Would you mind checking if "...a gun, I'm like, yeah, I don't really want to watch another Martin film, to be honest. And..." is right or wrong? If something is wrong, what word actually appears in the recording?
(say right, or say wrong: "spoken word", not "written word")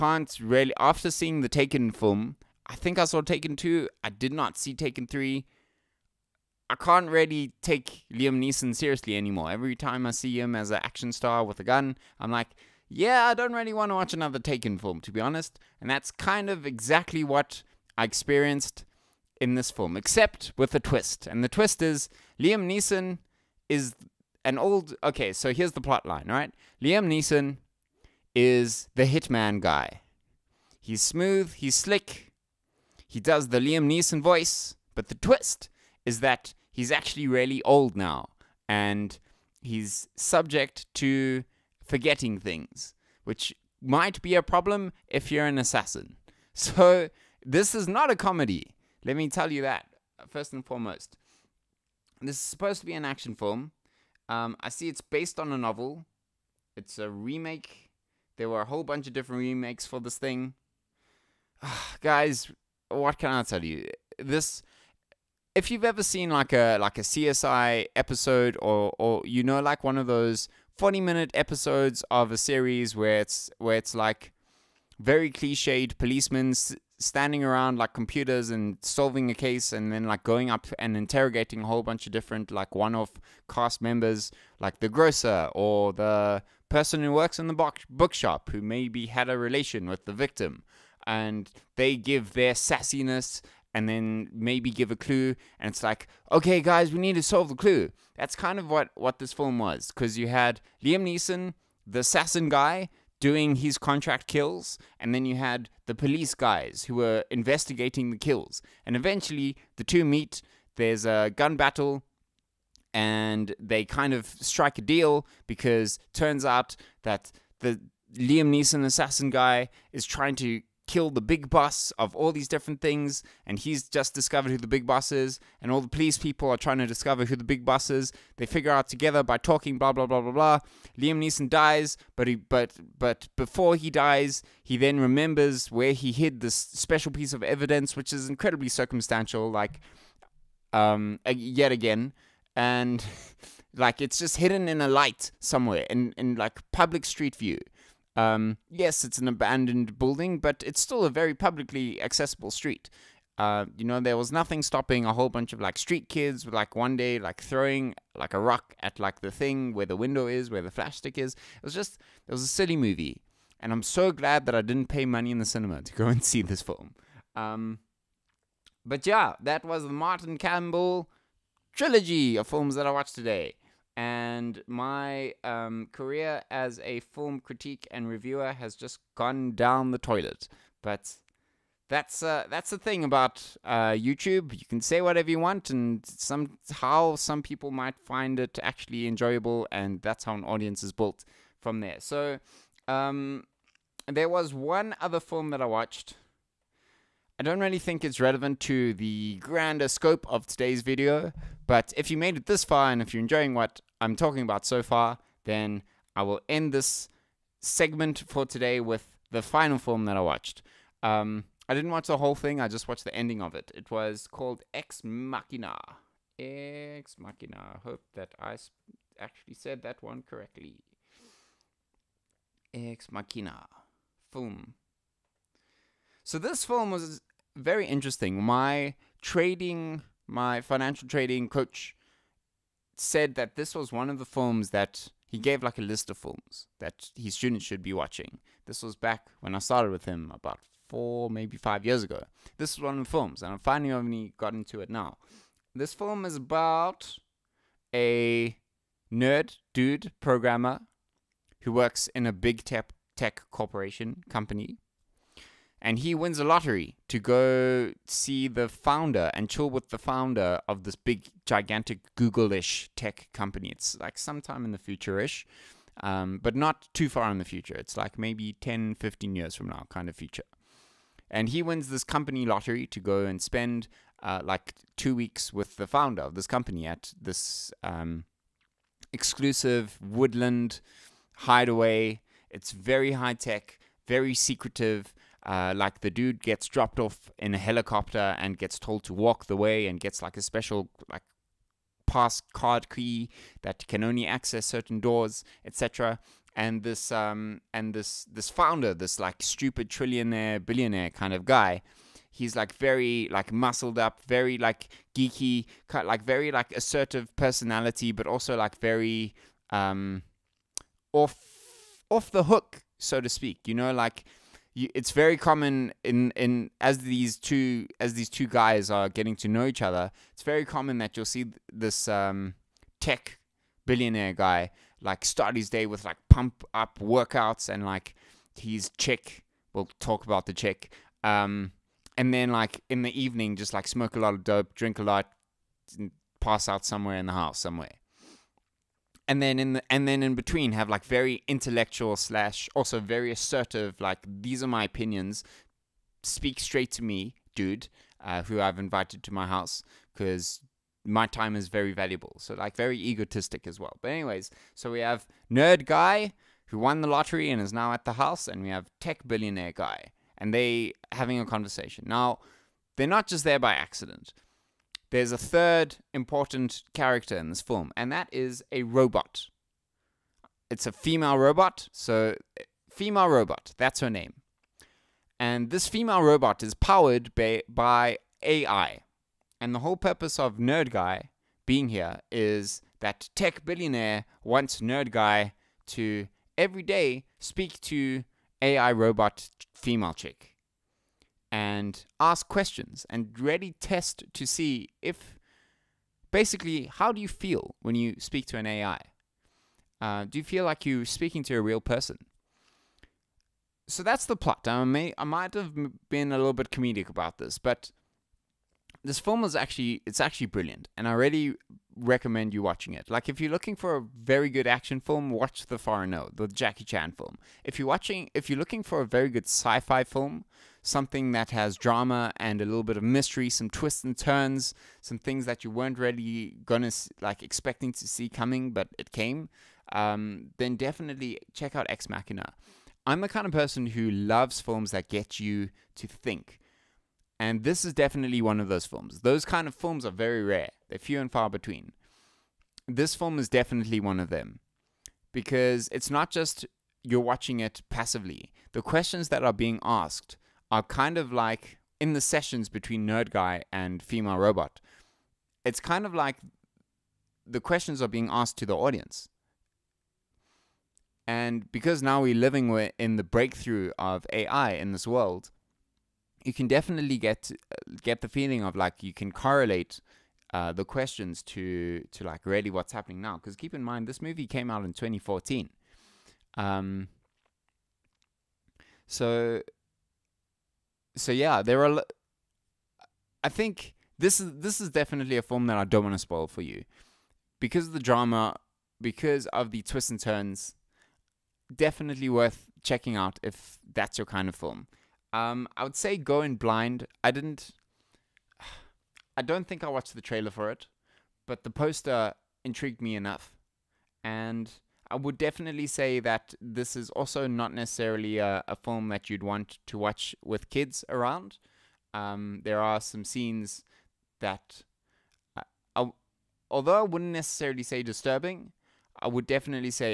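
wrong: "Taken", not "Martin".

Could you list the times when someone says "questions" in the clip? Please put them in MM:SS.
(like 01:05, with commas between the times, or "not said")
06:32, 07:28, 07:37, 07:50.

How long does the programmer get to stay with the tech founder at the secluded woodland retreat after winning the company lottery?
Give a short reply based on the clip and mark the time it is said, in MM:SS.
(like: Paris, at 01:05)
Two weeks, at 04:34.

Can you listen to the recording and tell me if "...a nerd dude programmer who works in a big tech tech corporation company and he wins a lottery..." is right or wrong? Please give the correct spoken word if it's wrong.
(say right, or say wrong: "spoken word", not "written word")
right.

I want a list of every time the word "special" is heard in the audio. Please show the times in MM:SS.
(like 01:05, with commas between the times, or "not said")
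02:16, 04:50.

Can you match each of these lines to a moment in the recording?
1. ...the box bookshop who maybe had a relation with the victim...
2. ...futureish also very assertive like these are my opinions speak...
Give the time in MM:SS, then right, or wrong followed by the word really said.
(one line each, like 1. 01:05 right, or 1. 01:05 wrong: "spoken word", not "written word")
1. 01:27 right
2. 05:42 wrong: "slash", not "futureish".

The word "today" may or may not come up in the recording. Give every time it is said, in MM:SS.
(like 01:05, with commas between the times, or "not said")
02:53, 03:20, 03:28.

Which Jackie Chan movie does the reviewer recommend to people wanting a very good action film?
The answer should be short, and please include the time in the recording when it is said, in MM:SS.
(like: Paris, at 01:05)
The Foreigner, at 06:55.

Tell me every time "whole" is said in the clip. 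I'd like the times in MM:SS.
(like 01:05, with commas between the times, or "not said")
00:58, 01:21, 02:35, 03:32, 06:19.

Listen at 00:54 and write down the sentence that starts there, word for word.
Um, I see it's based on a novel.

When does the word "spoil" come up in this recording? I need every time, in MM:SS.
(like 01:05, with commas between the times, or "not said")
08:06.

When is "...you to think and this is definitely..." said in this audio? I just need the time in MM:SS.
07:15.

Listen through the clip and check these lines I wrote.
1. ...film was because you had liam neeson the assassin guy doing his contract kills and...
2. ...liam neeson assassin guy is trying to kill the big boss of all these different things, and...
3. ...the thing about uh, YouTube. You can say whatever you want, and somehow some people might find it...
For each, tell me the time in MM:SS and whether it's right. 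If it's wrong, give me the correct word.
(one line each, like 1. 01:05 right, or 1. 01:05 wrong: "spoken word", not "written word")
1. 01:39 right
2. 01:58 right
3. 03:02 right.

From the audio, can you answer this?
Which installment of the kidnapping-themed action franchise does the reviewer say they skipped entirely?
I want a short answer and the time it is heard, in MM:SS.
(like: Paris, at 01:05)
Taken 3, at 00:04.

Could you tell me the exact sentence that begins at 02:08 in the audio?
They figure out together by talking, blah blah blah blah blah.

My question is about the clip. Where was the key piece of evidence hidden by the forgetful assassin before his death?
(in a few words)
In a light.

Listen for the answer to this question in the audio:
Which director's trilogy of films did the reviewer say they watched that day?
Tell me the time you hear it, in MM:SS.
02:49.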